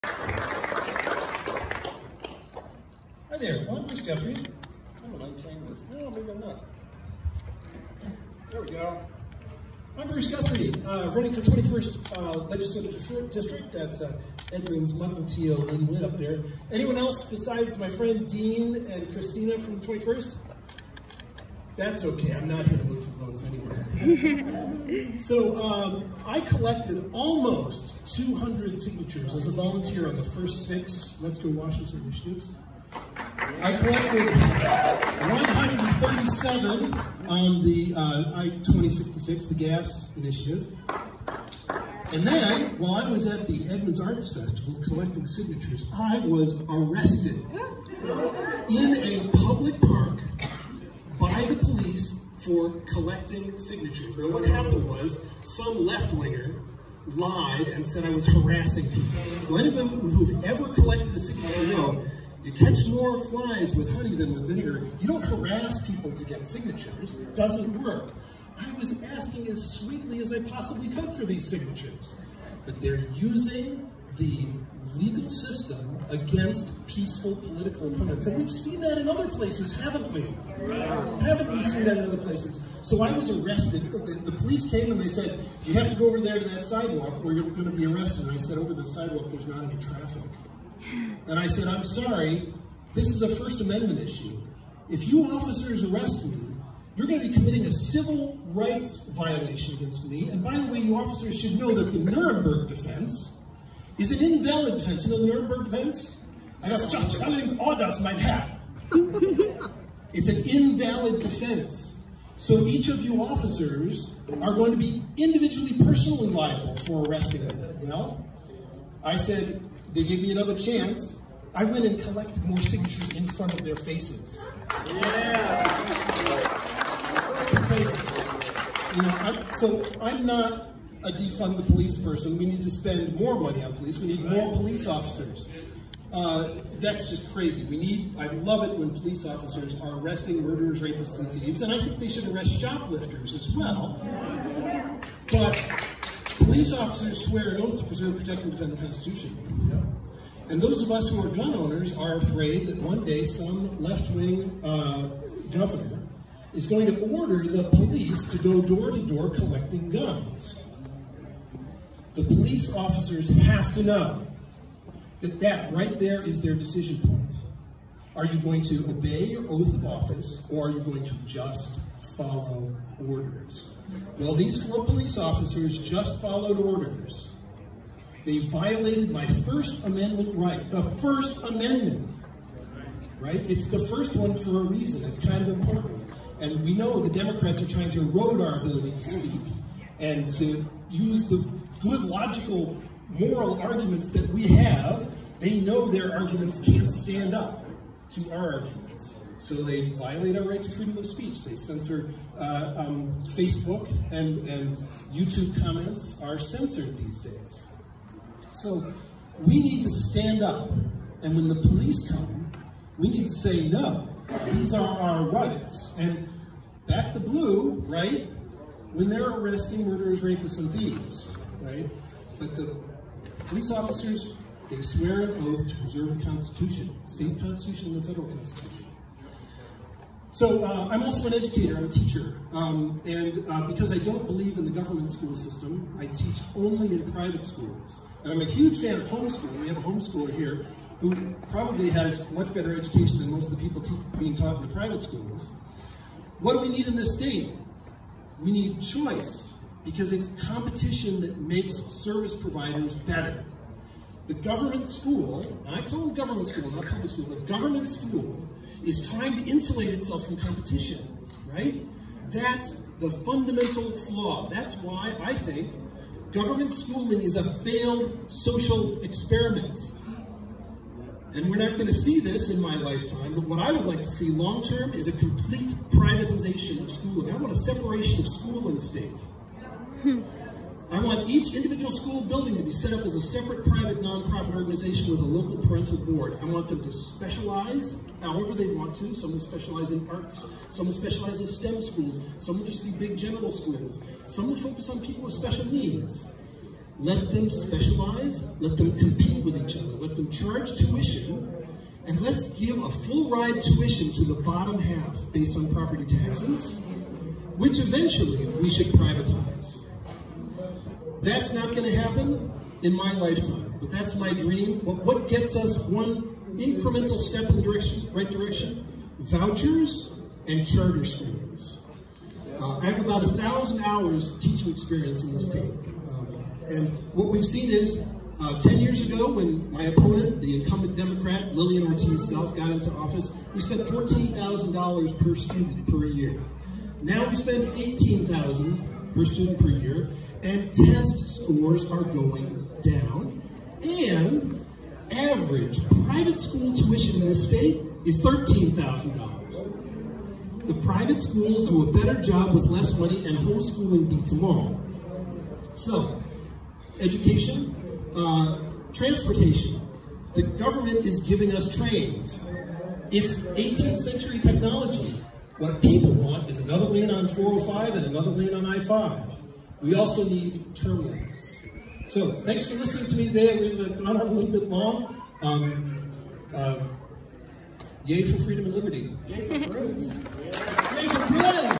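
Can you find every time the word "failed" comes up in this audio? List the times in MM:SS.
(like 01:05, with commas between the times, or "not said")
04:27.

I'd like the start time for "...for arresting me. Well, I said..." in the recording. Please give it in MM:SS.
01:56.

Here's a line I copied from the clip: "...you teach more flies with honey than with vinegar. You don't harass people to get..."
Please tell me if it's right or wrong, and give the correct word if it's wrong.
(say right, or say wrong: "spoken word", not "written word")
wrong: "catch", not "teach".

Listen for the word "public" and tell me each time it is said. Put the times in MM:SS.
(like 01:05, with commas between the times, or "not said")
00:49, 04:16.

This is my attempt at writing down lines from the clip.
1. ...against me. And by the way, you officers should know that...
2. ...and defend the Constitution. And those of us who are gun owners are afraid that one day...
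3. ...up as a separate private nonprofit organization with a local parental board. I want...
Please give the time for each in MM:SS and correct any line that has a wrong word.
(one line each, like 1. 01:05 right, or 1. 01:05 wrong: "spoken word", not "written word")
1. 01:39 right
2. 02:28 right
3. 04:42 right.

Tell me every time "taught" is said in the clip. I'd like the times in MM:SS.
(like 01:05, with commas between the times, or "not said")
04:04.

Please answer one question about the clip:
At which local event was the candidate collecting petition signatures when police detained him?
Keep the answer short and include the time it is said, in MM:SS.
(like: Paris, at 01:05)
Edmonds Arts Festival, at 00:43.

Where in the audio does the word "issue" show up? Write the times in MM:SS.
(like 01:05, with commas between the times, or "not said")
01:33.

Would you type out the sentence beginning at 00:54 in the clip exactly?
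Now, what happened was some left-winger lied and said I was harassing people.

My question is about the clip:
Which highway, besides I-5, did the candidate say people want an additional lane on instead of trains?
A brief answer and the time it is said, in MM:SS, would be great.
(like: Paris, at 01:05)
405, at 06:07.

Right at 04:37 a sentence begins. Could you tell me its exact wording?
I want a separation of school and state.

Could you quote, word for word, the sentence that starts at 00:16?
Anyone else besides my friend Dean and Kristina from the 21st?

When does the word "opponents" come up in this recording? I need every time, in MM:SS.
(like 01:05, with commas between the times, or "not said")
01:17, 05:29.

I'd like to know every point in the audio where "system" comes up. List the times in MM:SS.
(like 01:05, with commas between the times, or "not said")
01:15, 03:55.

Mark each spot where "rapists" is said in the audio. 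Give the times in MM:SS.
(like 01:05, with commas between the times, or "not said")
02:20, 03:40.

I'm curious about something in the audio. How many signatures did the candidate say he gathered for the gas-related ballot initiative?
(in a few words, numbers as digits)
137.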